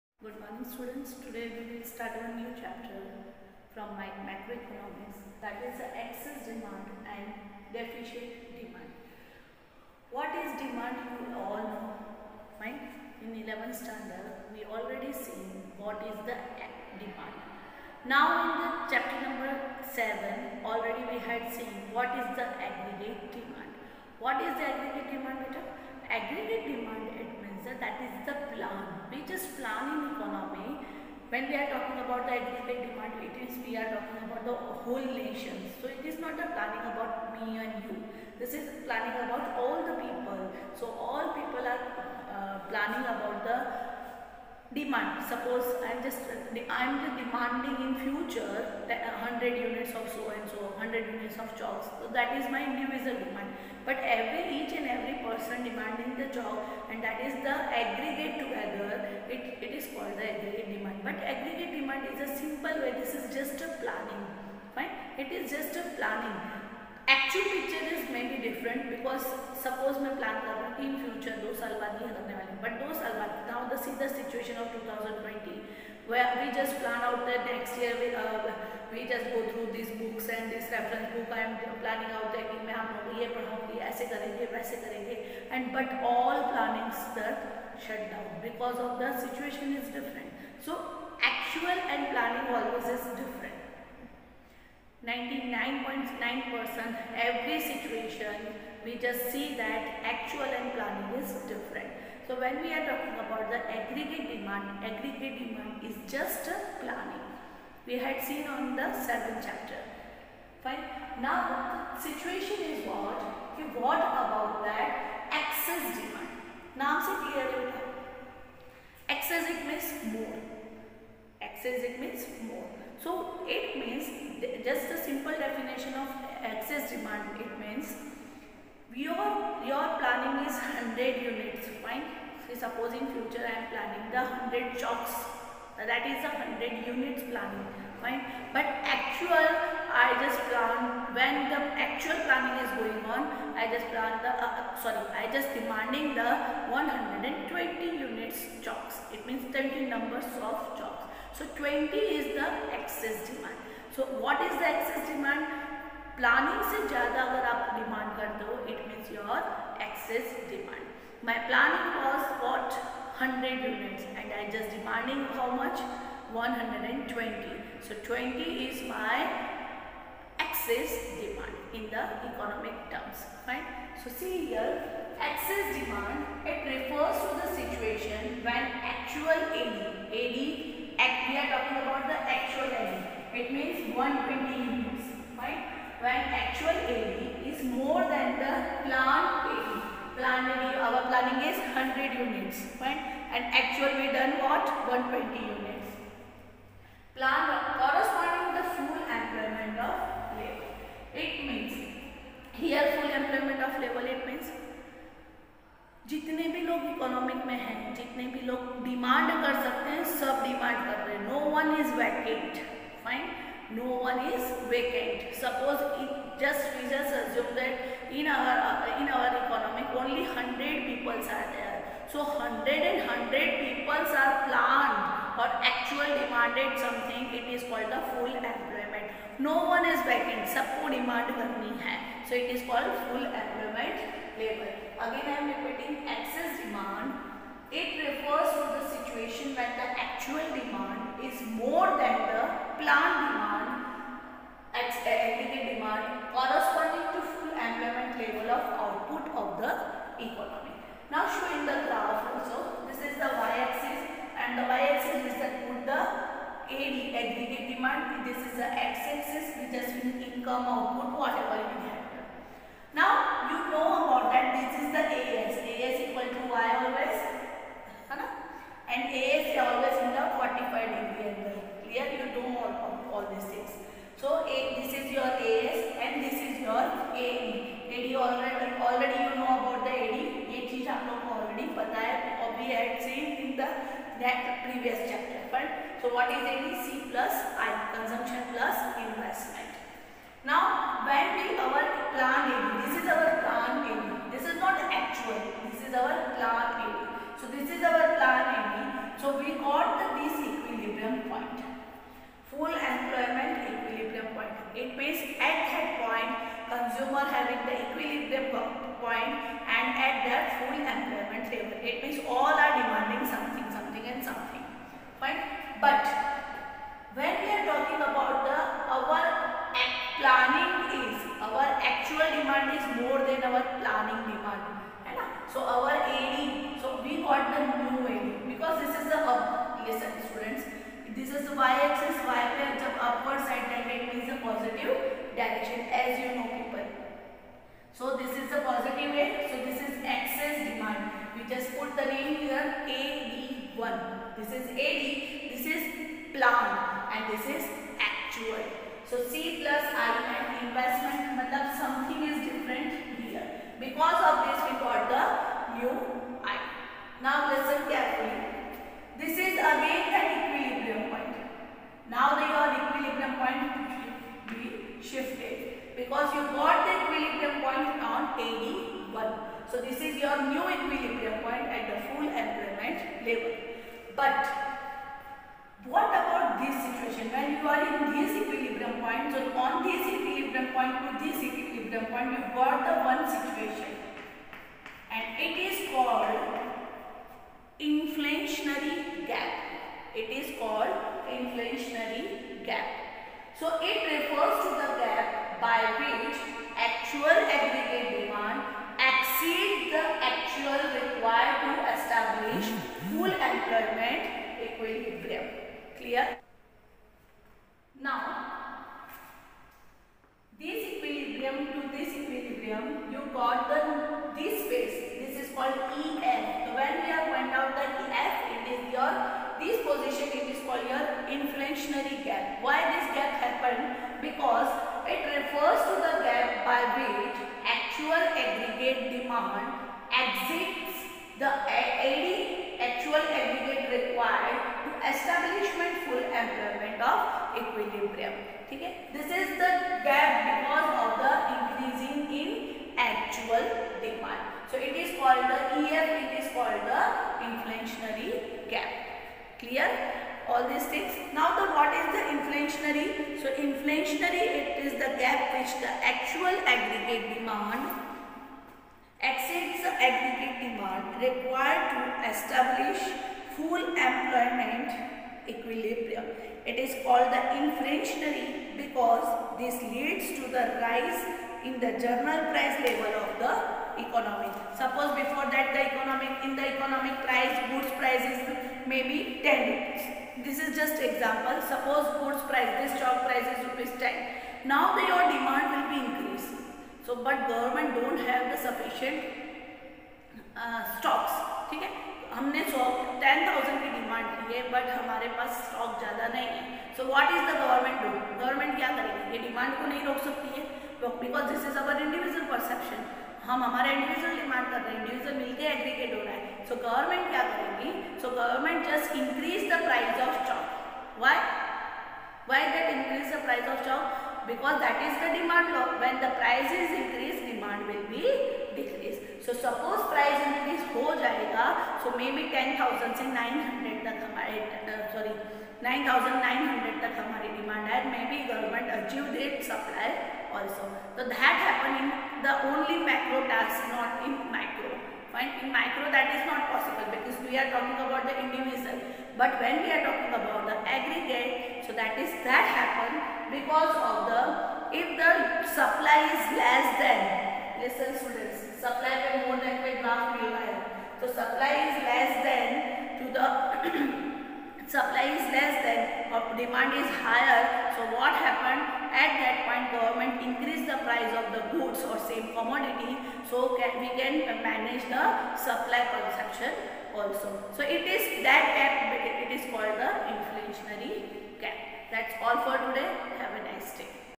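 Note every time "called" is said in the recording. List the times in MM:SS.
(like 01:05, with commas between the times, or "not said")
00:59, 06:25, 06:30, 06:55, 07:00, 07:47, 09:29.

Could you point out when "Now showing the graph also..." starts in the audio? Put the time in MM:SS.
04:11.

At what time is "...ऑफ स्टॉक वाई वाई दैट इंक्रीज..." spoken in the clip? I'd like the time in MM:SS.
08:30.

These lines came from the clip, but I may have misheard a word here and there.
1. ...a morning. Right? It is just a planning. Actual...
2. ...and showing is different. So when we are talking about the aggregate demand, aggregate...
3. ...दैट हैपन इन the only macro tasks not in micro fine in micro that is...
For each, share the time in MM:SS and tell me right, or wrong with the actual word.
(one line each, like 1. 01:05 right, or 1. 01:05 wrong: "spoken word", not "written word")
1. 01:03 wrong: "planning", not "morning"
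2. 01:40 wrong: "planning", not "showing"
3. 08:51 right.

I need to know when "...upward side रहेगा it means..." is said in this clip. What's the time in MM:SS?
05:33.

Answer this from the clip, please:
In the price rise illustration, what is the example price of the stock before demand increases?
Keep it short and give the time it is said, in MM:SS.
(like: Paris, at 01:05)
Rs 10, at 08:03.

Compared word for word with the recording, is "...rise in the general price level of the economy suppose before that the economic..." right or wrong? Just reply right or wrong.
right.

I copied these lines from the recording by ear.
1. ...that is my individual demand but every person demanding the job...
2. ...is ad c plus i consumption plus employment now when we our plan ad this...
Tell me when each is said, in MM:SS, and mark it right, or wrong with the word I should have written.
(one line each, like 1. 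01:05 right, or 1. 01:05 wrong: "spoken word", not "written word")
1. 00:52 right
2. 04:46 wrong: "investment", not "employment".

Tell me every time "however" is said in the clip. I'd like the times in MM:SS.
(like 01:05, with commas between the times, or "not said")
not said.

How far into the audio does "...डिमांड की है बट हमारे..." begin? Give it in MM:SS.
08:13.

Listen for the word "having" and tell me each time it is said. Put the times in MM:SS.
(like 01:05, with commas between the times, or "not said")
05:07.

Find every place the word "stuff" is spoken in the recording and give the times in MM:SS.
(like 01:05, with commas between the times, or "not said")
01:26.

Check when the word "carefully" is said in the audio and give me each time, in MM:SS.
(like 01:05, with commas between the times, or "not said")
05:57.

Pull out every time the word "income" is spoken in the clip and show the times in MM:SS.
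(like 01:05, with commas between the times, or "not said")
04:20.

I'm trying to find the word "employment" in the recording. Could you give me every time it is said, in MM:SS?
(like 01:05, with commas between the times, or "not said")
04:07, 05:02, 05:10, 07:44.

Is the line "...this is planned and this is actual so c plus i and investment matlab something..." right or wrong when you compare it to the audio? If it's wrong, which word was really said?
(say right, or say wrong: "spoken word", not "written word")
right.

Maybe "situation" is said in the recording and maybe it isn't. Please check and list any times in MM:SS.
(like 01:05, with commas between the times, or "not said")
01:29, 01:37, 01:51, 02:57, 06:23.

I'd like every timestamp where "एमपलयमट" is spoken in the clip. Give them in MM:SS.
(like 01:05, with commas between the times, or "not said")
03:48, 03:53.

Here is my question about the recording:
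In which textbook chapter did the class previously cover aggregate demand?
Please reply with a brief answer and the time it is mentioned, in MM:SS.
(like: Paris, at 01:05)
7, at 00:18.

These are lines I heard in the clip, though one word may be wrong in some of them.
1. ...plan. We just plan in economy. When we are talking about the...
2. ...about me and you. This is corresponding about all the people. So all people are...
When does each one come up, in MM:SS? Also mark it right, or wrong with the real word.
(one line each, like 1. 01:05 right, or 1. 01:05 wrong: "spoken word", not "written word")
1. 00:28 right
2. 00:36 wrong: "planning", not "corresponding".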